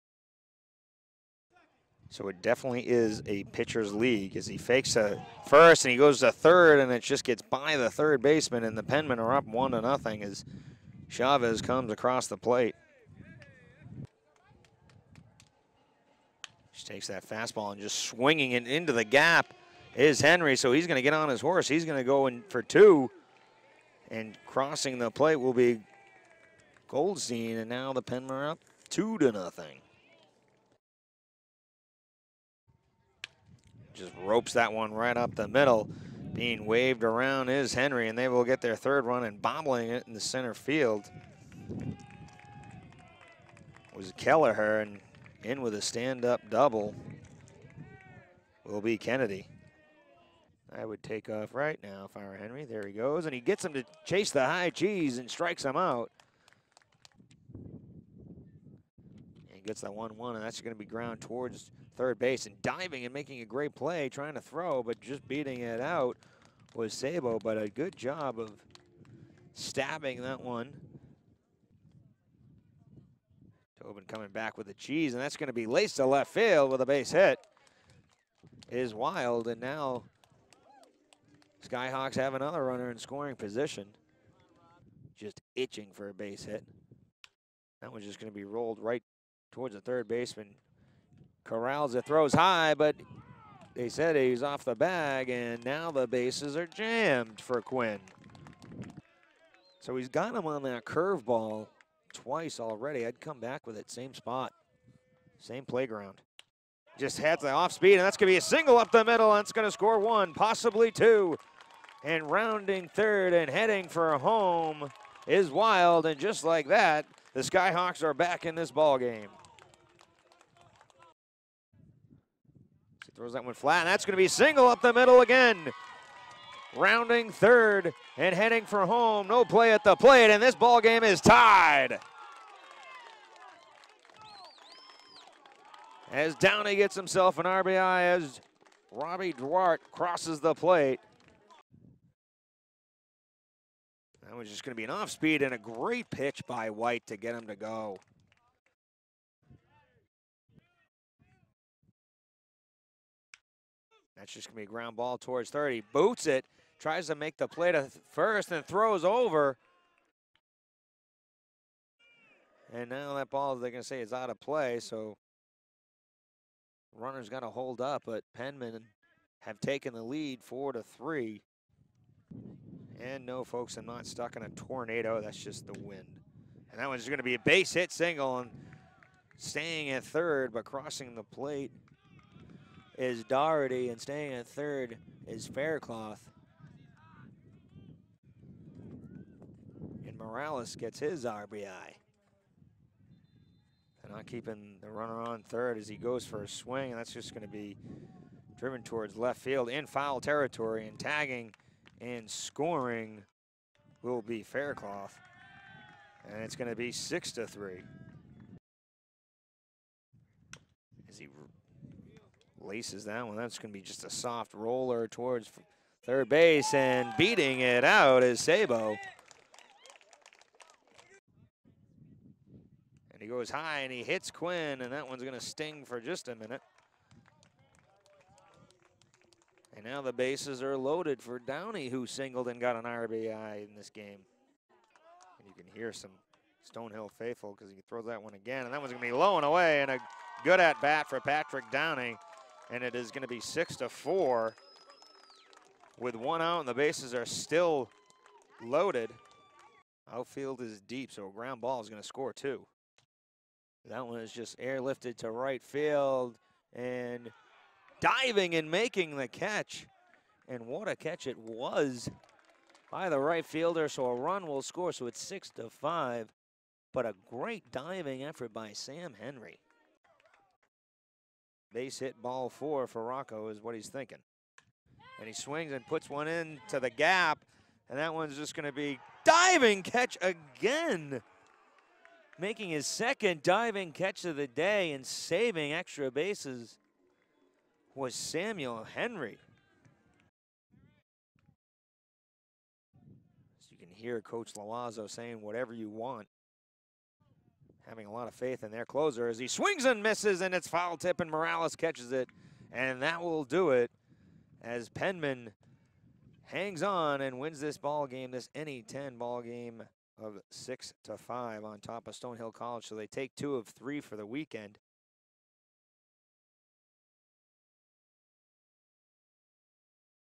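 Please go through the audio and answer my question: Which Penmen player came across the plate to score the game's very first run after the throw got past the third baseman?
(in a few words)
Chavez.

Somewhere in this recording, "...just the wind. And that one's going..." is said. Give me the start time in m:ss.
2:55.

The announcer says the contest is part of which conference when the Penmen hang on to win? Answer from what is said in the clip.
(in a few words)
NE10.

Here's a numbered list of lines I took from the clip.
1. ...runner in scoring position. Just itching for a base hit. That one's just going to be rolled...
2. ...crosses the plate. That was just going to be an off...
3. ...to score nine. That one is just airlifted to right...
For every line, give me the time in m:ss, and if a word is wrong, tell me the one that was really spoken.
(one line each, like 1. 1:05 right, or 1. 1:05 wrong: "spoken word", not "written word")
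1. 1:22 right
2. 2:19 right
3. 4:12 wrong: "two", not "nine".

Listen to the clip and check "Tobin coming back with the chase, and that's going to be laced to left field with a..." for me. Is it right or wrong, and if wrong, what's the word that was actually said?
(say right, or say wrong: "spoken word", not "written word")
wrong: "cheese", not "chase".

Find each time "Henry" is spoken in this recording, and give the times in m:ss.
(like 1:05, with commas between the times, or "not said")
0:20, 0:37, 0:52, 4:29, 4:48.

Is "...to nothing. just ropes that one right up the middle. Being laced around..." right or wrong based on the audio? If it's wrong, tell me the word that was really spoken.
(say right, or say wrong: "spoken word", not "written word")
wrong: "waved", not "laced".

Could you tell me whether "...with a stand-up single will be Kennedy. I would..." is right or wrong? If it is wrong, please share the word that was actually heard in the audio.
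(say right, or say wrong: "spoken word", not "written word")
wrong: "double", not "single".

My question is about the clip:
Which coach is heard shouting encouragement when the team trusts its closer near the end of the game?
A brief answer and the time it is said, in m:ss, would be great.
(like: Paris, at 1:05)
Coach Loiseau, at 4:54.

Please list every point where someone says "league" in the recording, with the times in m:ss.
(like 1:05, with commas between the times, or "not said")
0:03.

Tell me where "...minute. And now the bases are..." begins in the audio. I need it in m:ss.
3:46.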